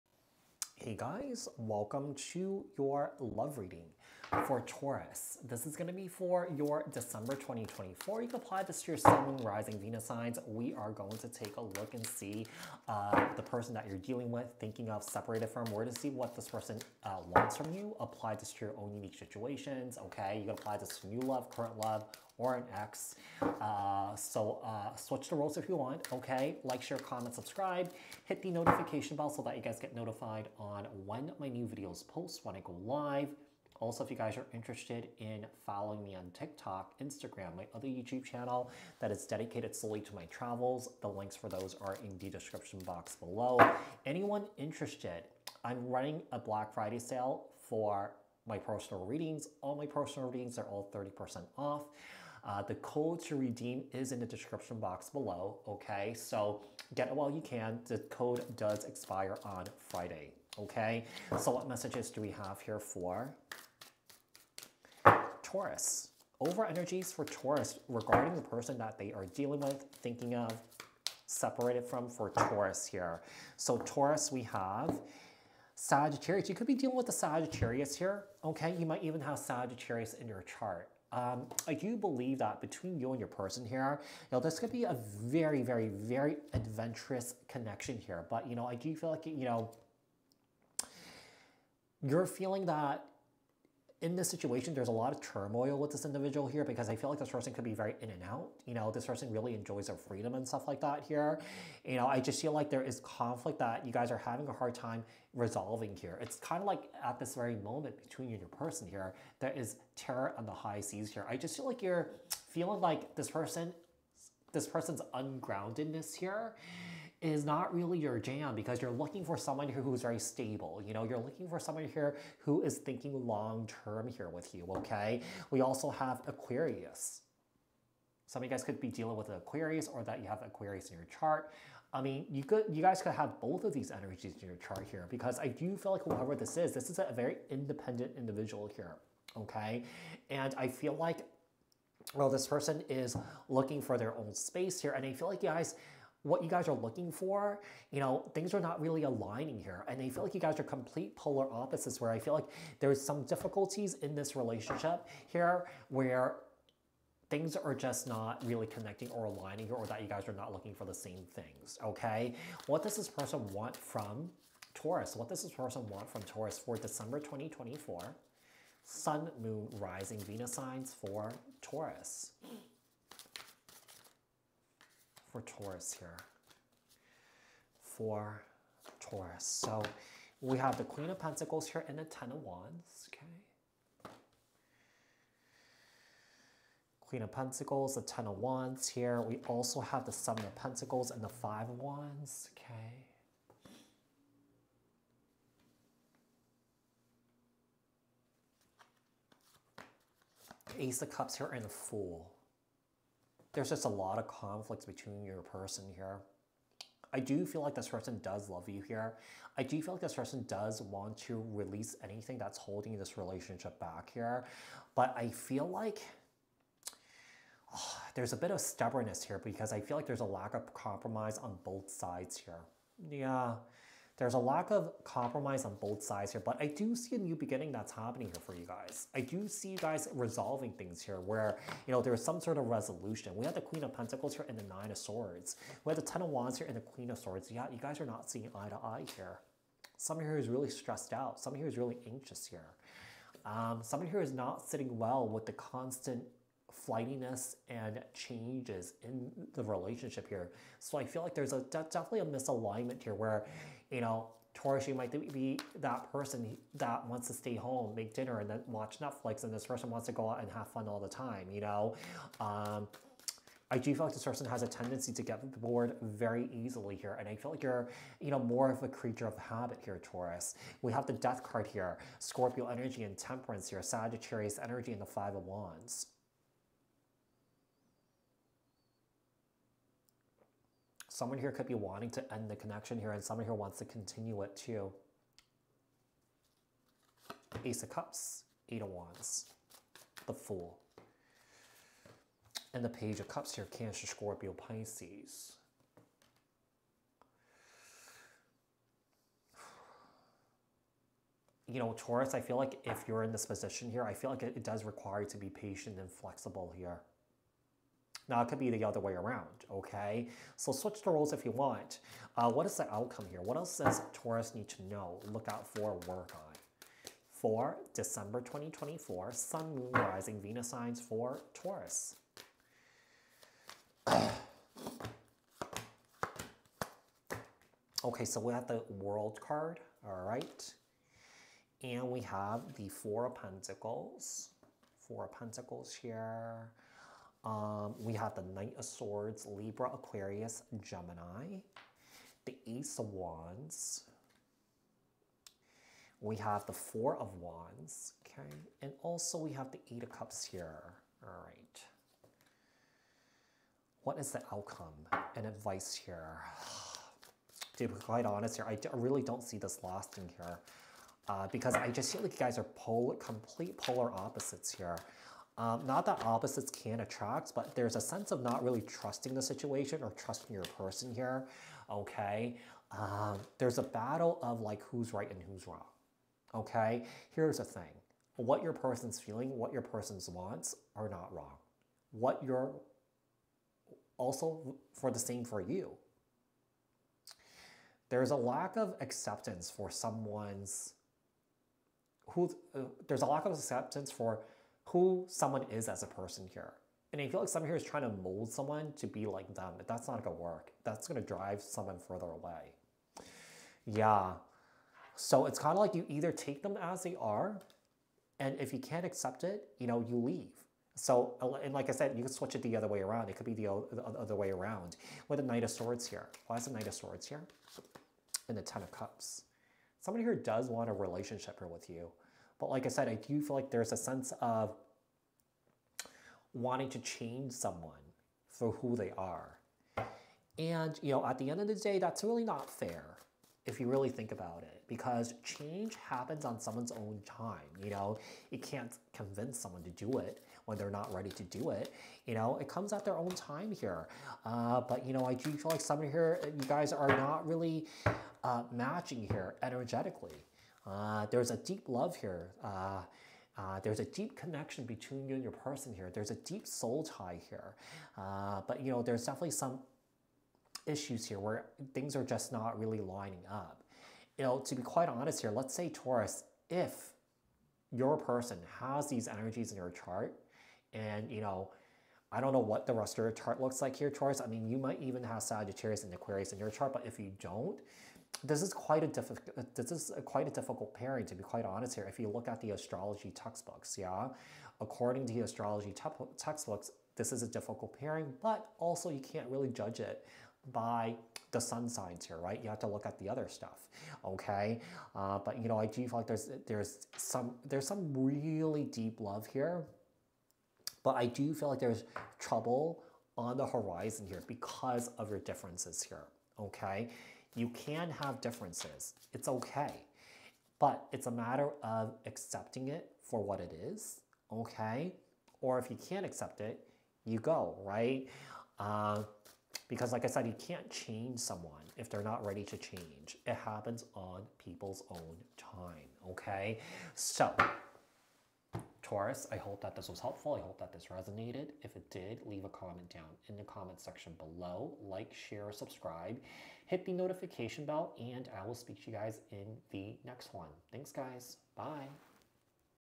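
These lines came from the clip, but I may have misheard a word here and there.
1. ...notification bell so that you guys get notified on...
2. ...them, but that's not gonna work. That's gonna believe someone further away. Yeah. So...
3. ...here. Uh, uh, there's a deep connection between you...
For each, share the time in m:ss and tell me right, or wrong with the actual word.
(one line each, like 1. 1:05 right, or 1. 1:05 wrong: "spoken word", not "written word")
1. 0:28 right
2. 6:39 wrong: "drive", not "believe"
3. 7:32 right.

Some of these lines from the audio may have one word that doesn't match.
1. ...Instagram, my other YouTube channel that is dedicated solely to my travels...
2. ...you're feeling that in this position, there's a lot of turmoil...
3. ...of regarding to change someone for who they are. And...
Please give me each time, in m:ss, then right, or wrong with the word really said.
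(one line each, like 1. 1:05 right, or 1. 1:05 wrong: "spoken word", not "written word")
1. 0:36 right
2. 1:32 wrong: "situation", not "position"
3. 7:04 wrong: "wanting", not "regarding".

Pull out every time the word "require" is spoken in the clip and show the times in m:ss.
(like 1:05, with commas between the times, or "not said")
5:04.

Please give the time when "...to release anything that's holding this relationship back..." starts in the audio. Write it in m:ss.
3:31.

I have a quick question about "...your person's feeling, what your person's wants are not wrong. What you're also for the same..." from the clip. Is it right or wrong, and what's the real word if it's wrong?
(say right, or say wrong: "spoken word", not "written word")
right.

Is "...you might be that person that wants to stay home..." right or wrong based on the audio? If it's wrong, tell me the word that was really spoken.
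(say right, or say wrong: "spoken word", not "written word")
right.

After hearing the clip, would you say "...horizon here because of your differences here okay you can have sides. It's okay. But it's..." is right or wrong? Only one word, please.
wrong.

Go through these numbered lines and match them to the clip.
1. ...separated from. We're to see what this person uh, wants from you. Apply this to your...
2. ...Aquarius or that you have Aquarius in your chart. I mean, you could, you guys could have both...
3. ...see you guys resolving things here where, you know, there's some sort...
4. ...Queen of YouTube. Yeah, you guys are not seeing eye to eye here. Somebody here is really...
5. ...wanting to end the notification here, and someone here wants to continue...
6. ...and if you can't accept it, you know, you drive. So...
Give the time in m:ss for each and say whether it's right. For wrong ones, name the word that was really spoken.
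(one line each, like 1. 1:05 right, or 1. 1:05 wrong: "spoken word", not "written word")
1. 0:15 right
2. 2:09 right
3. 3:49 right
4. 3:56 wrong: "Swords", not "YouTube"
5. 4:41 wrong: "connection", not "notification"
6. 6:48 wrong: "leave", not "drive".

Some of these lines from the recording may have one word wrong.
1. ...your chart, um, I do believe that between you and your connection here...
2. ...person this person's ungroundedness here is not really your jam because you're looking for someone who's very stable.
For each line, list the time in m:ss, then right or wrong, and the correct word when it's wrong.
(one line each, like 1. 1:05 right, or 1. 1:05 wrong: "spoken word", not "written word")
1. 1:20 wrong: "person", not "connection"
2. 1:53 right.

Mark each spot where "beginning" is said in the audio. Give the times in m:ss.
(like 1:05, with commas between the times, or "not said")
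3:47.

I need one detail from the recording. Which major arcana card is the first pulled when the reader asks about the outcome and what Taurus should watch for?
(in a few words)
The World.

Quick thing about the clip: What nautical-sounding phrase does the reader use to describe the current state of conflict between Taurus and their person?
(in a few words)
terror on the high seas.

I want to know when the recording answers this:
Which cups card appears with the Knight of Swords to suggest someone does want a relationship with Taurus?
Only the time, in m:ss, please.
6:58.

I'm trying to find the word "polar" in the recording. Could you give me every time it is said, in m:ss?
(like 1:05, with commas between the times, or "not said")
2:31, 6:03.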